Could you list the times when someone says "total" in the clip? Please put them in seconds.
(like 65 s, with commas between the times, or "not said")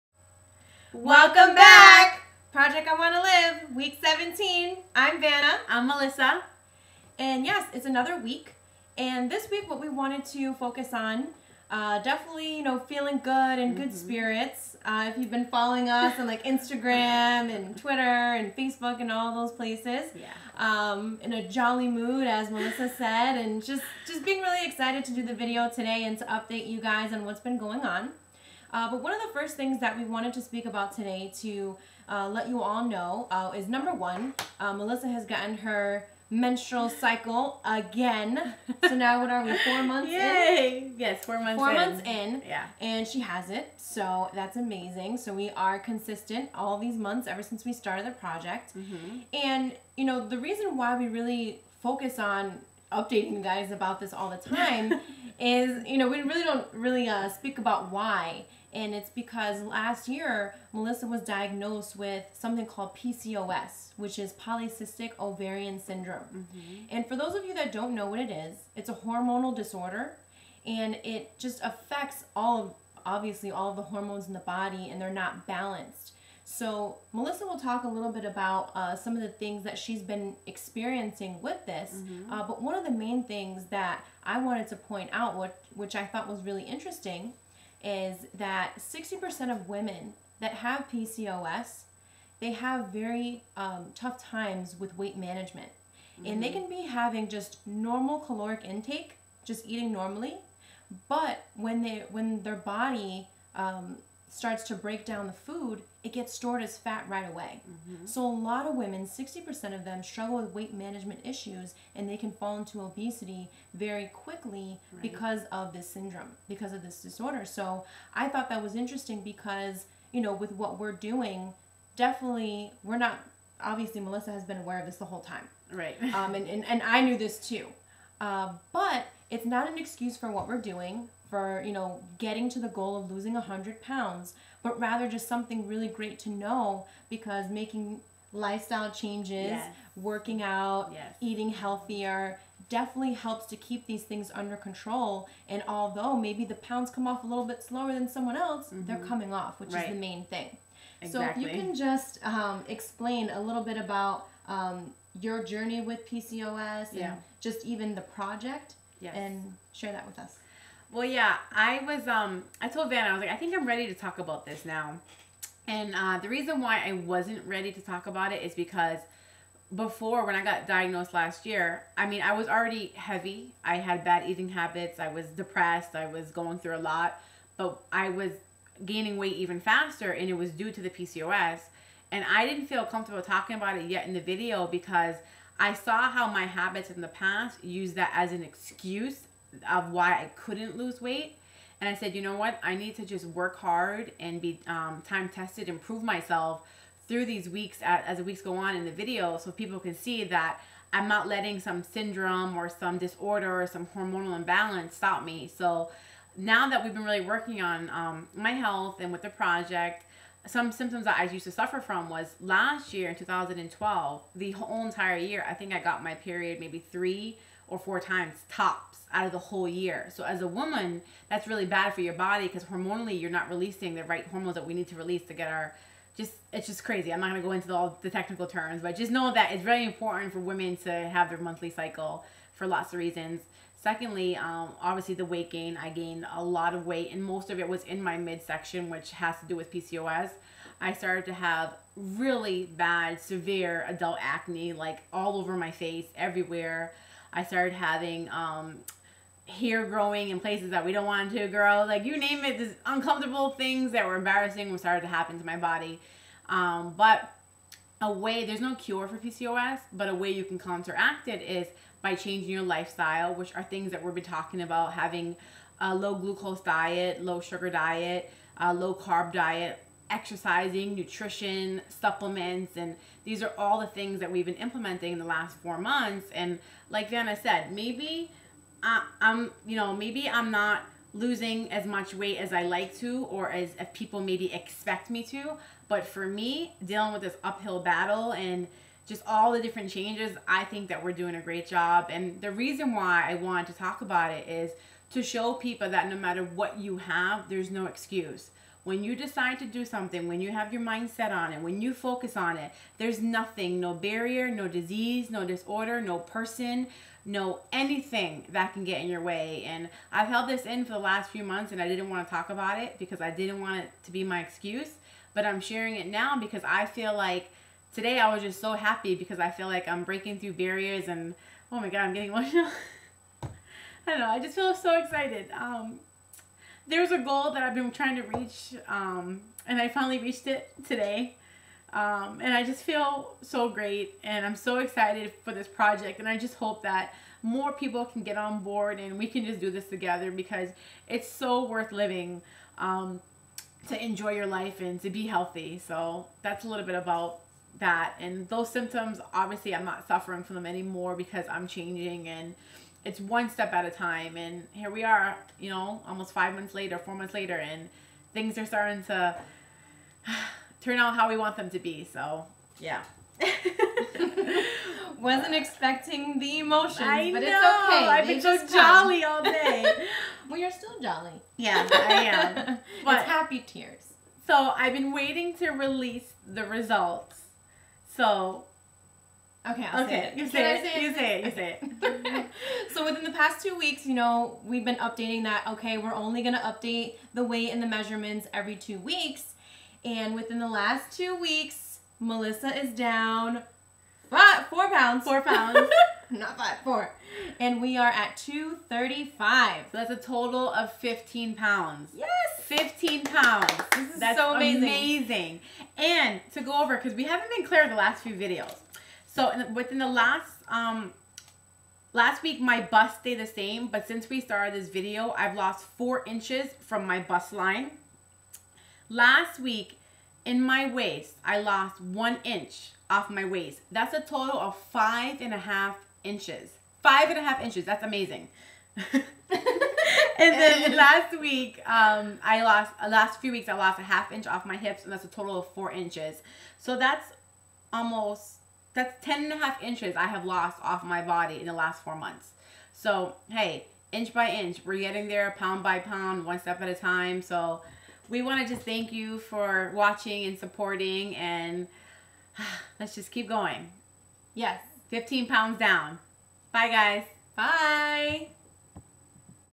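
400 s, 424 s, 435 s.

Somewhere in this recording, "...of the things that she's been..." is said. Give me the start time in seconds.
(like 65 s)
79 s.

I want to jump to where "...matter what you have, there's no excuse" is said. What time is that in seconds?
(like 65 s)
296 s.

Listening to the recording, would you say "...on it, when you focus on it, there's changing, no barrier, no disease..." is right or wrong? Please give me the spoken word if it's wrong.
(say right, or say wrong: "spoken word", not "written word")
wrong: "nothing", not "changing".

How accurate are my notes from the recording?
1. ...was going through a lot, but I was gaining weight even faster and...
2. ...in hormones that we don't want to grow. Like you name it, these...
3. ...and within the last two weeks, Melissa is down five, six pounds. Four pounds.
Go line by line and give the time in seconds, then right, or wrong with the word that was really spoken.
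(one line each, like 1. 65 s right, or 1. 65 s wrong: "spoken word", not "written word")
1. 176 s right
2. 250 s wrong: "places", not "hormones"
3. 390 s wrong: "four", not "six".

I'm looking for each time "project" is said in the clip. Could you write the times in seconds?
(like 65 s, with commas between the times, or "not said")
2 s, 48 s, 158 s, 209 s, 335 s.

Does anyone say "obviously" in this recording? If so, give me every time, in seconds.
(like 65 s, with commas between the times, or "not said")
73 s, 123 s, 234 s, 349 s.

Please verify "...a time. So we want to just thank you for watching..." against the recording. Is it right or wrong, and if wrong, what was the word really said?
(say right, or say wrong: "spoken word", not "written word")
right.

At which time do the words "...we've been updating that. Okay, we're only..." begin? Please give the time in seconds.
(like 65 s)
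384 s.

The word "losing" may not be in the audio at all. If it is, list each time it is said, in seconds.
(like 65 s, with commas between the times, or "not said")
133 s, 281 s.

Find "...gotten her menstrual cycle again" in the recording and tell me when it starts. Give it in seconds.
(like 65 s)
35 s.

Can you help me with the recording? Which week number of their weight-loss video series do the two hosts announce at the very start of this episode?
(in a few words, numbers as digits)
17.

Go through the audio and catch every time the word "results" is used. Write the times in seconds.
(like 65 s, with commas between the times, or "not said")
376 s.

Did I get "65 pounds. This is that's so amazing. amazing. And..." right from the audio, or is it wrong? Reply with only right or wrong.
wrong.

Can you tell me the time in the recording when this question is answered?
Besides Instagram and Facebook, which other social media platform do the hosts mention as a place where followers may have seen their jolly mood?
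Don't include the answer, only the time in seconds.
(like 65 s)
17 s.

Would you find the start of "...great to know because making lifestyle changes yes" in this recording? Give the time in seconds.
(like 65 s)
135 s.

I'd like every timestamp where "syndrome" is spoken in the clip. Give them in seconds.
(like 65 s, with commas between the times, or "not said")
65 s, 115 s, 201 s.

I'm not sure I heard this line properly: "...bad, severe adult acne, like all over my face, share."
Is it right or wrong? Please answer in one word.
wrong.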